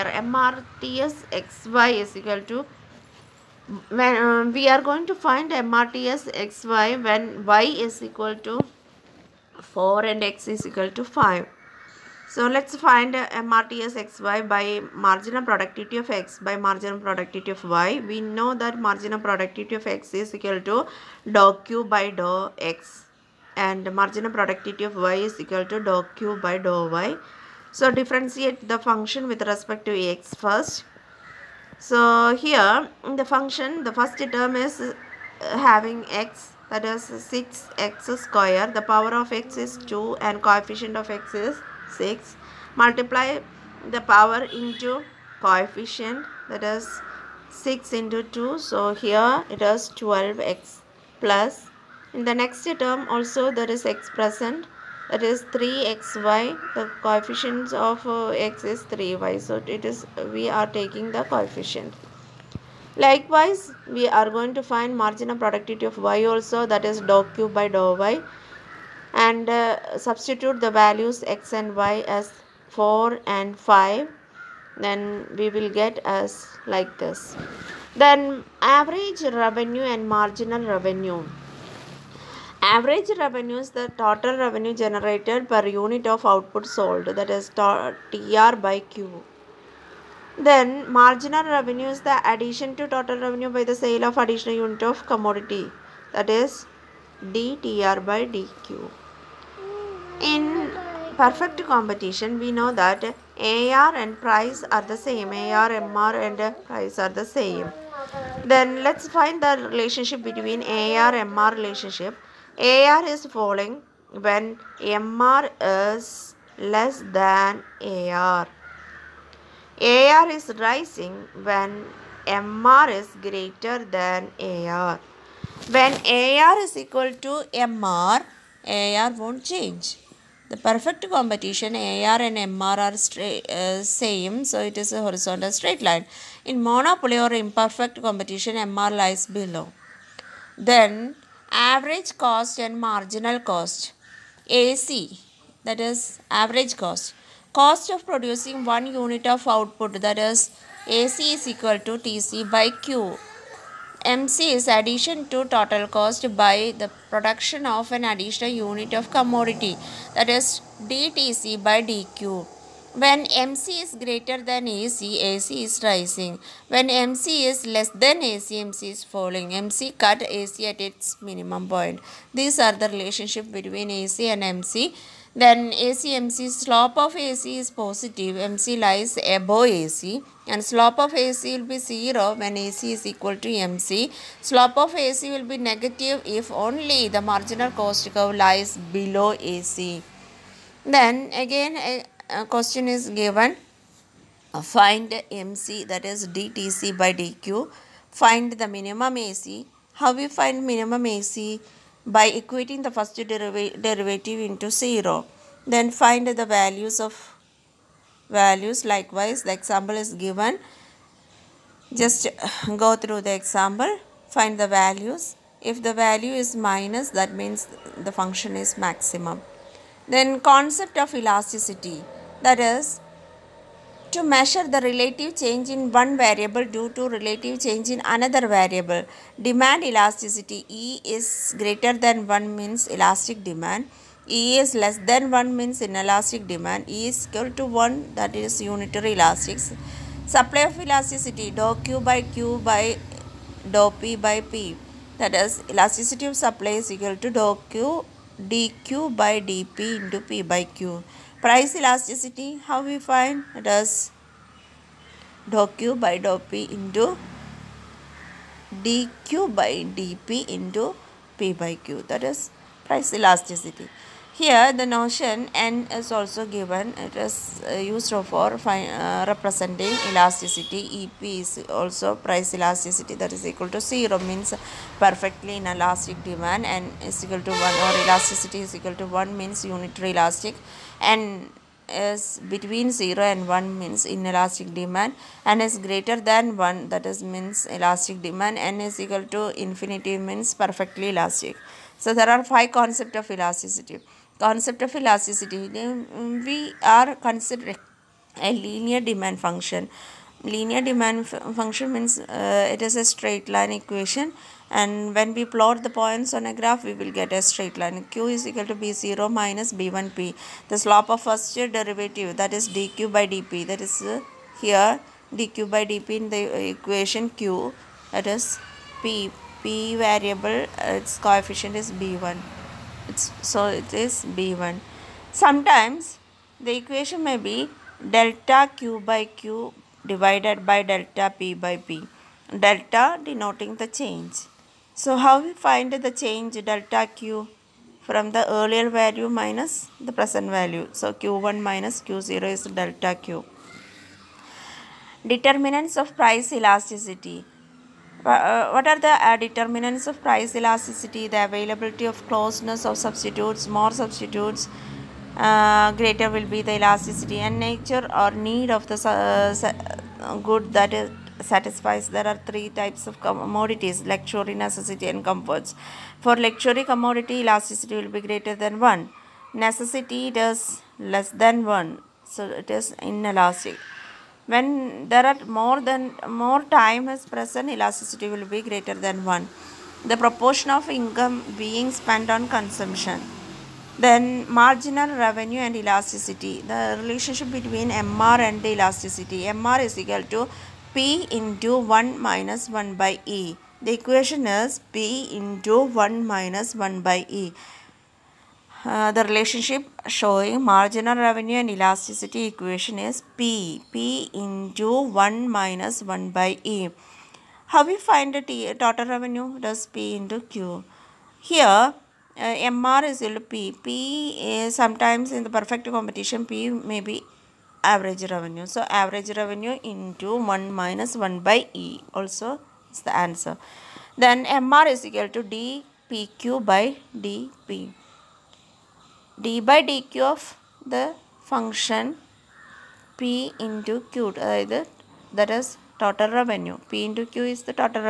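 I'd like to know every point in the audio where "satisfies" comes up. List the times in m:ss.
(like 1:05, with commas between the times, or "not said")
6:01.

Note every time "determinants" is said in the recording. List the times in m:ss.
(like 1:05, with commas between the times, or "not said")
5:45, 5:49.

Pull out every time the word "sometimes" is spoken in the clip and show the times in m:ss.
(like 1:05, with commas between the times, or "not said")
5:25, 6:54.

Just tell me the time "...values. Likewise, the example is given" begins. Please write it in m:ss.
3:28.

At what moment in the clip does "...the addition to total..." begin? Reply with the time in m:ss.
1:32.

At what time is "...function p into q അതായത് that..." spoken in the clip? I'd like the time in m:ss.
7:11.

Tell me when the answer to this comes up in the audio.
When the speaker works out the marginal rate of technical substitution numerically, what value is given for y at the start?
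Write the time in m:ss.
0:07.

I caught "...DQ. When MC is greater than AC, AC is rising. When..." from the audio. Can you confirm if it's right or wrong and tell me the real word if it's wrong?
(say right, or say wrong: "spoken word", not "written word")
right.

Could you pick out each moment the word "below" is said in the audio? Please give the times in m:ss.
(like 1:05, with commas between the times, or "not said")
2:19, 3:08.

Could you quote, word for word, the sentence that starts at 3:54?
E is less than 1 means inelastic demand.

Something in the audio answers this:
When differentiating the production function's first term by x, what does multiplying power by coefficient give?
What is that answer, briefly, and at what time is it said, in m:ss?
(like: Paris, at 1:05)
12x, at 0:50.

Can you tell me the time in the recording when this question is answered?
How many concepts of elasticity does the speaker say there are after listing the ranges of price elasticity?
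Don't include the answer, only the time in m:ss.
4:52.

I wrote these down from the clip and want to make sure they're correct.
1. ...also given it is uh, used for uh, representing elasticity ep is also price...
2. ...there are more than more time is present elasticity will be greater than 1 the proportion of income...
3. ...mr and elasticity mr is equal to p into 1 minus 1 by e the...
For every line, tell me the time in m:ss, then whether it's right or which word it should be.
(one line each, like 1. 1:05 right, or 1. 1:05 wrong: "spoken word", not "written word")
1. 4:26 right
2. 6:15 right
3. 6:28 right.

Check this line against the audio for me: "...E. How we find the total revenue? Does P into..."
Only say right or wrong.
right.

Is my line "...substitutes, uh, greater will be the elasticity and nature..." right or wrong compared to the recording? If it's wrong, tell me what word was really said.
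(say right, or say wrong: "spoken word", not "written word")
right.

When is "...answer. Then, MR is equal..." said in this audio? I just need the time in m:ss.
7:03.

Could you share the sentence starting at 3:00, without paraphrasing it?
And slope of AC will be 0 when AC is equal to MC.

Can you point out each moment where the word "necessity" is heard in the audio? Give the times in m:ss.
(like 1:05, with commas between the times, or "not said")
6:04, 6:09.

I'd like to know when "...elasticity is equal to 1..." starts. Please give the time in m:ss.
4:38.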